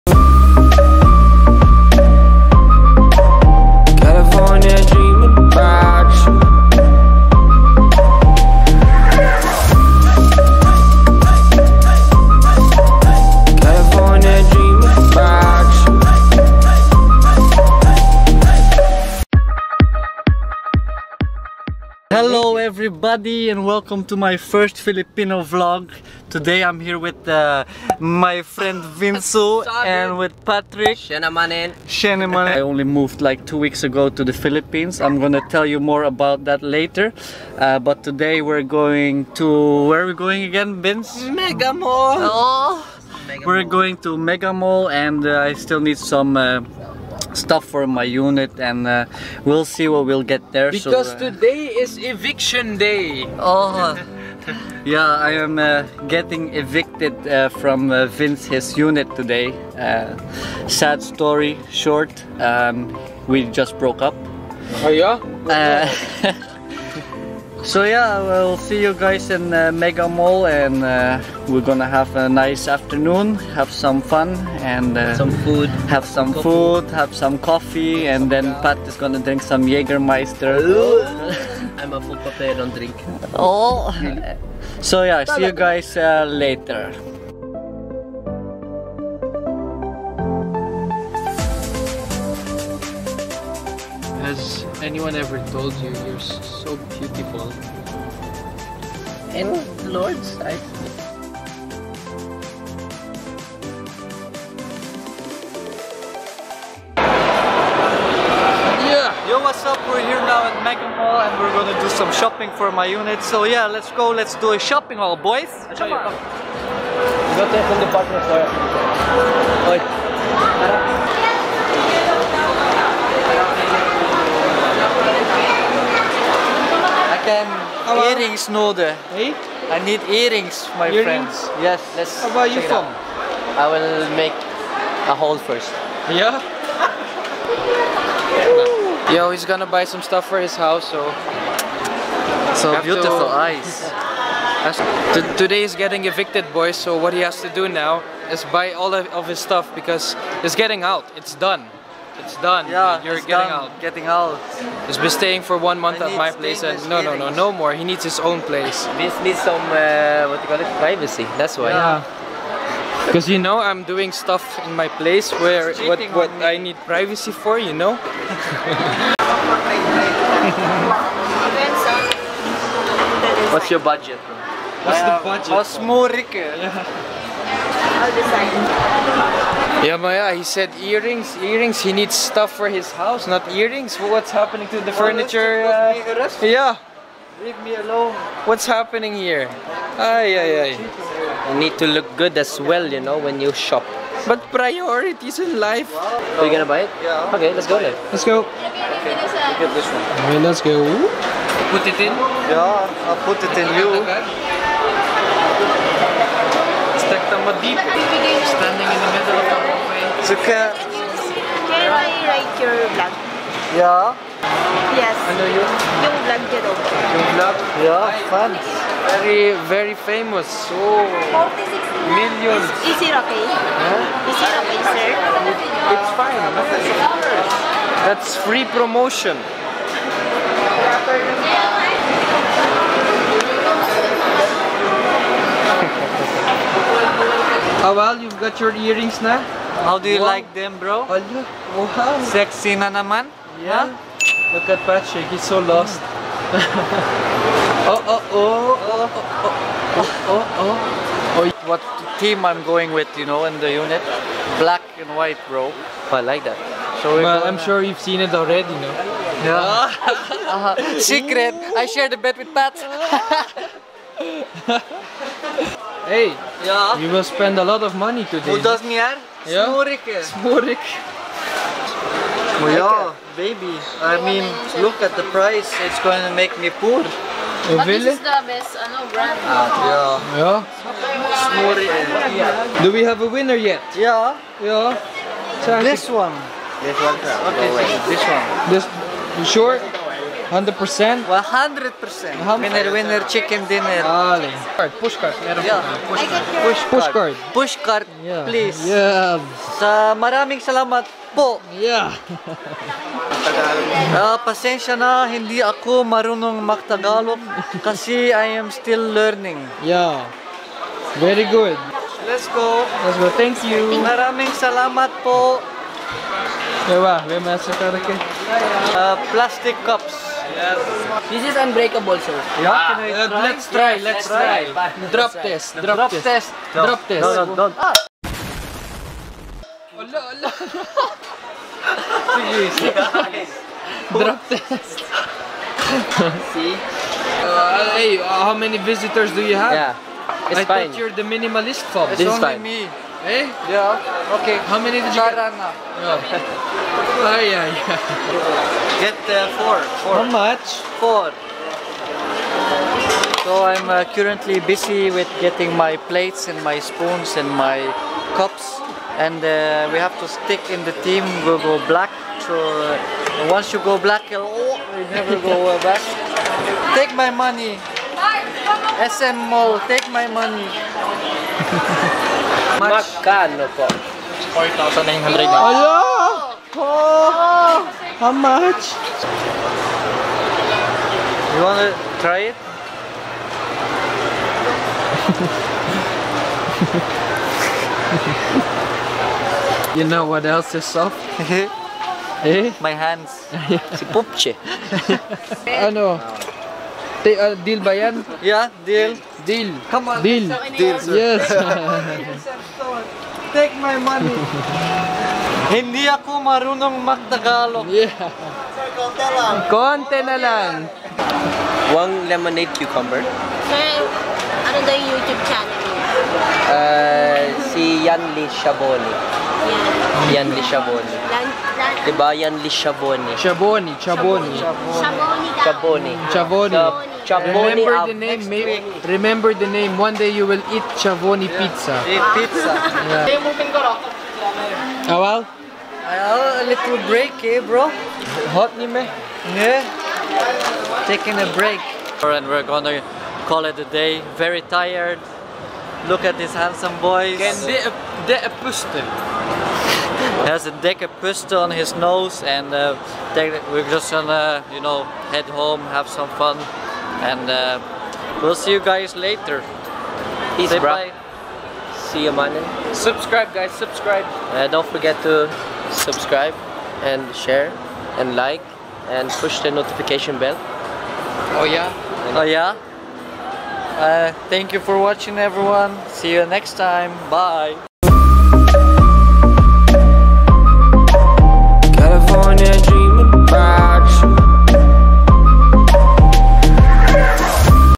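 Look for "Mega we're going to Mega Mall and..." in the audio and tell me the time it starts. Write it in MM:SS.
00:43.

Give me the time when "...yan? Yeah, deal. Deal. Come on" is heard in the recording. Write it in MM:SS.
06:37.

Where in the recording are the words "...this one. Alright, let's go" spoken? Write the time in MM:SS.
03:19.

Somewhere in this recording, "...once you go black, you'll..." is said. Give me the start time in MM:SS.
06:03.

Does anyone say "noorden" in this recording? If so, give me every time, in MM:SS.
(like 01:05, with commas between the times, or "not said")
02:08.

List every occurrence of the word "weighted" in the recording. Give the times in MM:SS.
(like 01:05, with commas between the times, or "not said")
not said.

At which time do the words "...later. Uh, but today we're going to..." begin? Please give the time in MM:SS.
00:36.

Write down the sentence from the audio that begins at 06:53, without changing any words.
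Sir, ano daw yung YouTube channel niya?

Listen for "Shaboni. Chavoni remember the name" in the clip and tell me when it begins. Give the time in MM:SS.
07:06.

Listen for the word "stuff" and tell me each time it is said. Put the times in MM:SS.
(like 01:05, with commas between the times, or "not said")
00:47, 02:20, 02:29, 02:44, 03:02.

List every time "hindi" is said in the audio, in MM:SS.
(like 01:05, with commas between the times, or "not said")
05:05, 06:45.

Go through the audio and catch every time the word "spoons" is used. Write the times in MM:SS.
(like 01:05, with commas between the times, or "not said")
05:56.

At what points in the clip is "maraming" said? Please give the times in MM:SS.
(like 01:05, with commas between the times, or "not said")
05:00, 05:14.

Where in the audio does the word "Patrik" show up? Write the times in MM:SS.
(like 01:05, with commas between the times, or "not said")
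00:30, 04:04.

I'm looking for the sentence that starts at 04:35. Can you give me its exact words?
It's going to make me poor.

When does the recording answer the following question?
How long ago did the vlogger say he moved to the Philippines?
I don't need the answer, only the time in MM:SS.
00:33.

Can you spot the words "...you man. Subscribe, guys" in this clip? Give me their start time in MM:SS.
07:42.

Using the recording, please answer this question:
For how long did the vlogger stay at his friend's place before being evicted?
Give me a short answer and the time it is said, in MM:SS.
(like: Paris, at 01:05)
1 month, at 02:35.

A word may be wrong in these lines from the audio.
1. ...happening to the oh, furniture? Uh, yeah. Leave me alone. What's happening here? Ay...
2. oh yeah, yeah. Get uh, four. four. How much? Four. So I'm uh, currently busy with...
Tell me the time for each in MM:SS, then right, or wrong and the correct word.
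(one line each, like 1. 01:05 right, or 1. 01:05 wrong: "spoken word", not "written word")
1. 03:04 right
2. 05:47 right.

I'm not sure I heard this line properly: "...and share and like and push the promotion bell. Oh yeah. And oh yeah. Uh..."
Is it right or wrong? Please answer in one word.
wrong.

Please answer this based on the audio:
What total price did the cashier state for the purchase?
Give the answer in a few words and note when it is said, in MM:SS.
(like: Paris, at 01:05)
4,900, at 06:14.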